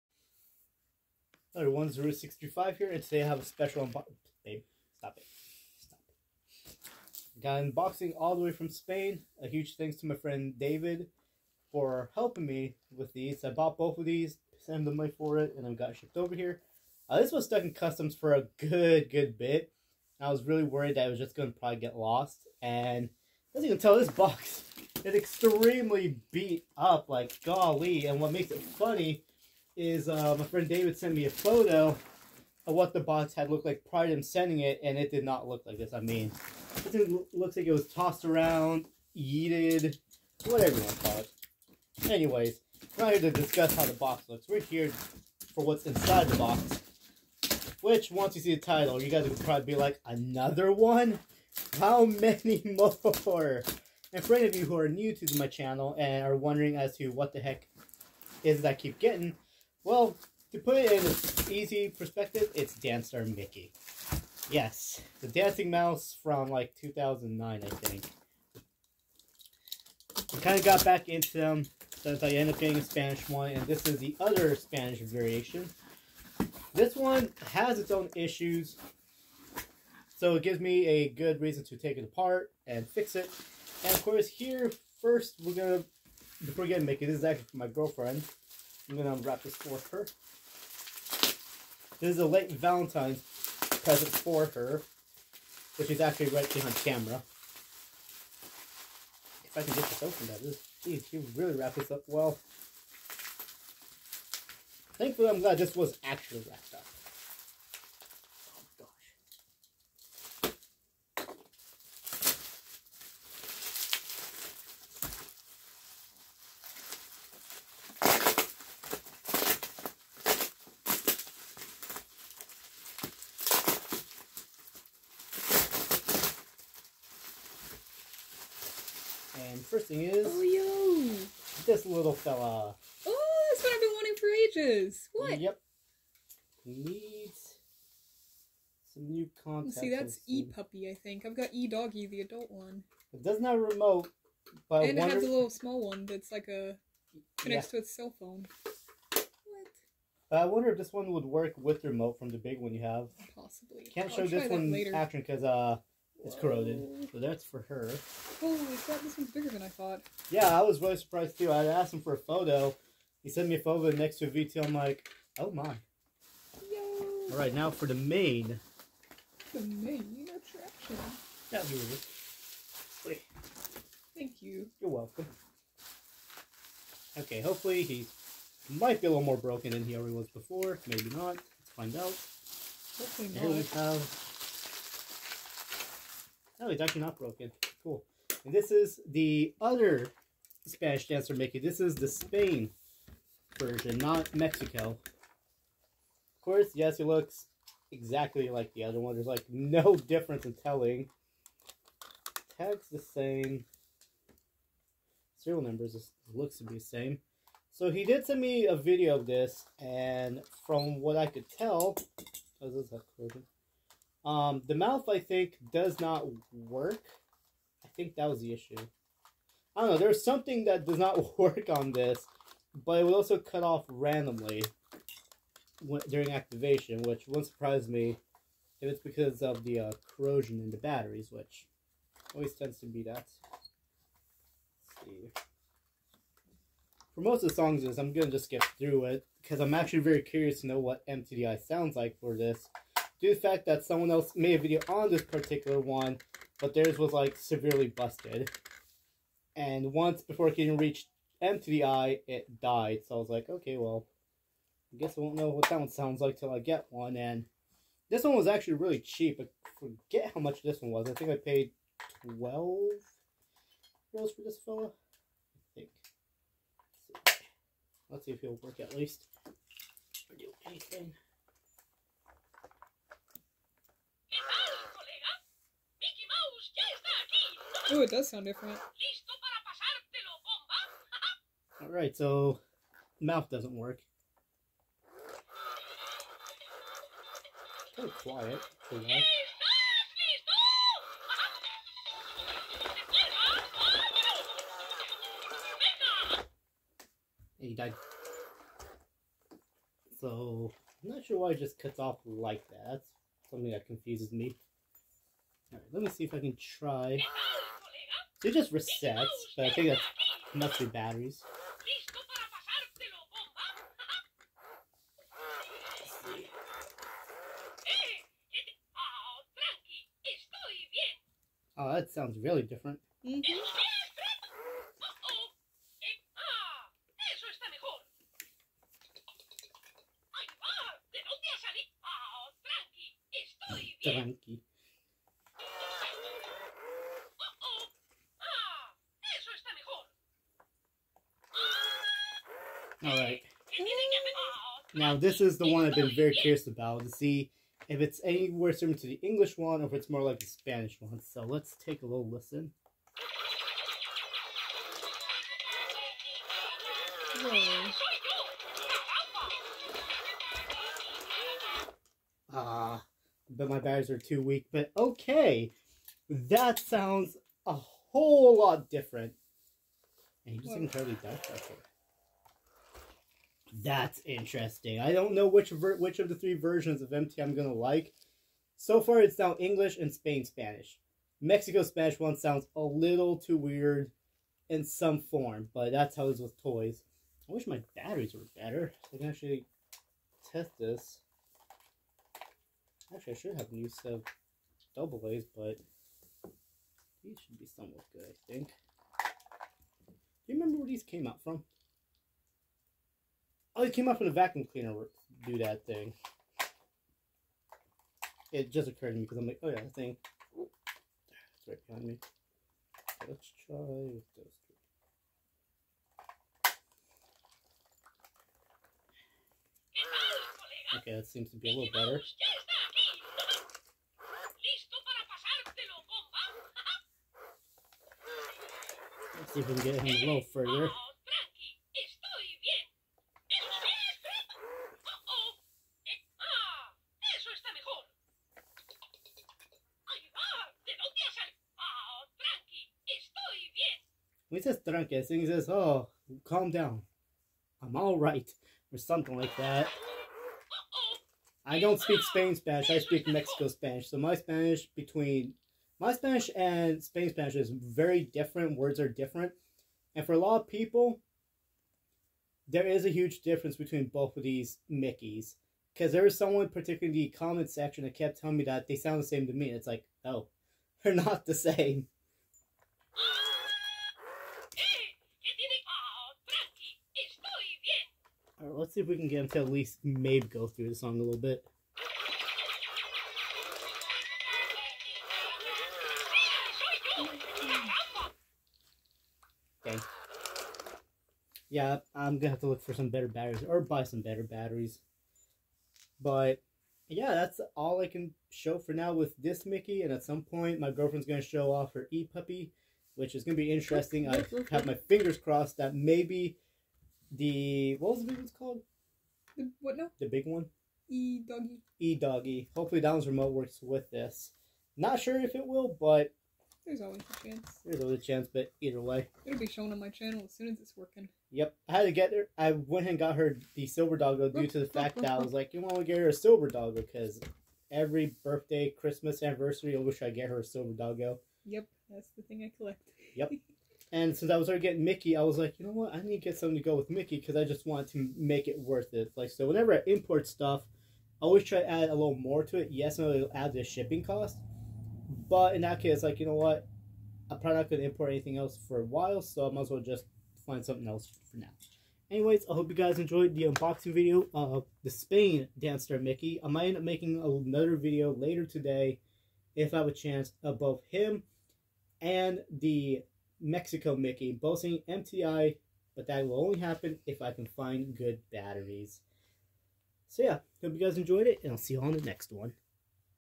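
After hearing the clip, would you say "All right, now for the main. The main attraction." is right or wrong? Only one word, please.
right.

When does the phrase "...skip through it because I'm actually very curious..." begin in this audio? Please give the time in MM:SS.
03:58.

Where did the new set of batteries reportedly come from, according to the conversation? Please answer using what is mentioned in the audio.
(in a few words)
a vacuum cleaner.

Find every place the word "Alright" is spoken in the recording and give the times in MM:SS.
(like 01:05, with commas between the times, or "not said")
04:41, 05:05, 05:43.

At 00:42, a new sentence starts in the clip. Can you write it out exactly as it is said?
Anyways, we're not here to discuss how the box looks.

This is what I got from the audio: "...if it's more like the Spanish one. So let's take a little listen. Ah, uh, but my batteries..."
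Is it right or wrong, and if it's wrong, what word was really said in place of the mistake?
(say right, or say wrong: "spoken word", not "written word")
right.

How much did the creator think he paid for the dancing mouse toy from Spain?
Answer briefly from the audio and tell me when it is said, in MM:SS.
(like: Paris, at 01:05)
12 euros, at 04:22.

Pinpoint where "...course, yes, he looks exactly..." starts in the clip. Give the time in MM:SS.
03:16.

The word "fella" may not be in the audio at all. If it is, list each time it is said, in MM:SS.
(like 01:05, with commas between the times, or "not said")
02:12, 04:24.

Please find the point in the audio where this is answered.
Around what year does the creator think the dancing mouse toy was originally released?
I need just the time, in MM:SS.
01:06.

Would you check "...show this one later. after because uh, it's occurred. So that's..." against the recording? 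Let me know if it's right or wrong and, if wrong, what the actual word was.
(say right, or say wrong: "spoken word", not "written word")
wrong: "corroded", not "occurred".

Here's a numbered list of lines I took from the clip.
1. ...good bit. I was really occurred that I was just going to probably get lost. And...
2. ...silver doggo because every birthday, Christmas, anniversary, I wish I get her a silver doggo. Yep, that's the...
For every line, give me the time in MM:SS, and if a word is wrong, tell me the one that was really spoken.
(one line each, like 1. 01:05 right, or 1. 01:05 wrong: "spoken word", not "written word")
1. 00:19 wrong: "worried", not "occurred"
2. 08:46 right.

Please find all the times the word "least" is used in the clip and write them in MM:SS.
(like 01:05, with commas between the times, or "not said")
04:28, 07:59.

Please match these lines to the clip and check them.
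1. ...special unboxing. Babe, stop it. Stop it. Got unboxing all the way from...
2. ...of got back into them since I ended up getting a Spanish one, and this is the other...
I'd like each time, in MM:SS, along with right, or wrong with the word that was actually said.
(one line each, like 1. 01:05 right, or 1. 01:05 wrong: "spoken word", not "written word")
1. 00:03 right
2. 01:10 right.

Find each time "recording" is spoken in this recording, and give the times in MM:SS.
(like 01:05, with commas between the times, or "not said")
not said.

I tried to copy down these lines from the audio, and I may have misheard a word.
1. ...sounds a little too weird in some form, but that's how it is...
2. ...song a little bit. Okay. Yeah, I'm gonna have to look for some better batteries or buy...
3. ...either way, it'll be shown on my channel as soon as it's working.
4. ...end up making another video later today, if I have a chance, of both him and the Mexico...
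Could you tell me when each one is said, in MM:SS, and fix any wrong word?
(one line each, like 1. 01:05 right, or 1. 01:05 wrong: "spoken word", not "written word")
1. 06:22 right
2. 08:00 right
3. 08:38 right
4. 09:16 right.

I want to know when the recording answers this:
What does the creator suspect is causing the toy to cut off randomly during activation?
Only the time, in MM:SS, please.
03:50.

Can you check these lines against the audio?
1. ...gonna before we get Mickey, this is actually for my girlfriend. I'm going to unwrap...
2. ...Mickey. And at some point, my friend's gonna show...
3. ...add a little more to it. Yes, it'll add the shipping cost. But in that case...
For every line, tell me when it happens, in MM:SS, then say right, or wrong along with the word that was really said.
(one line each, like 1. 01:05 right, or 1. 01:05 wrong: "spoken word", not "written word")
1. 01:25 right
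2. 08:19 wrong: "girlfriend", not "friend"
3. 09:01 right.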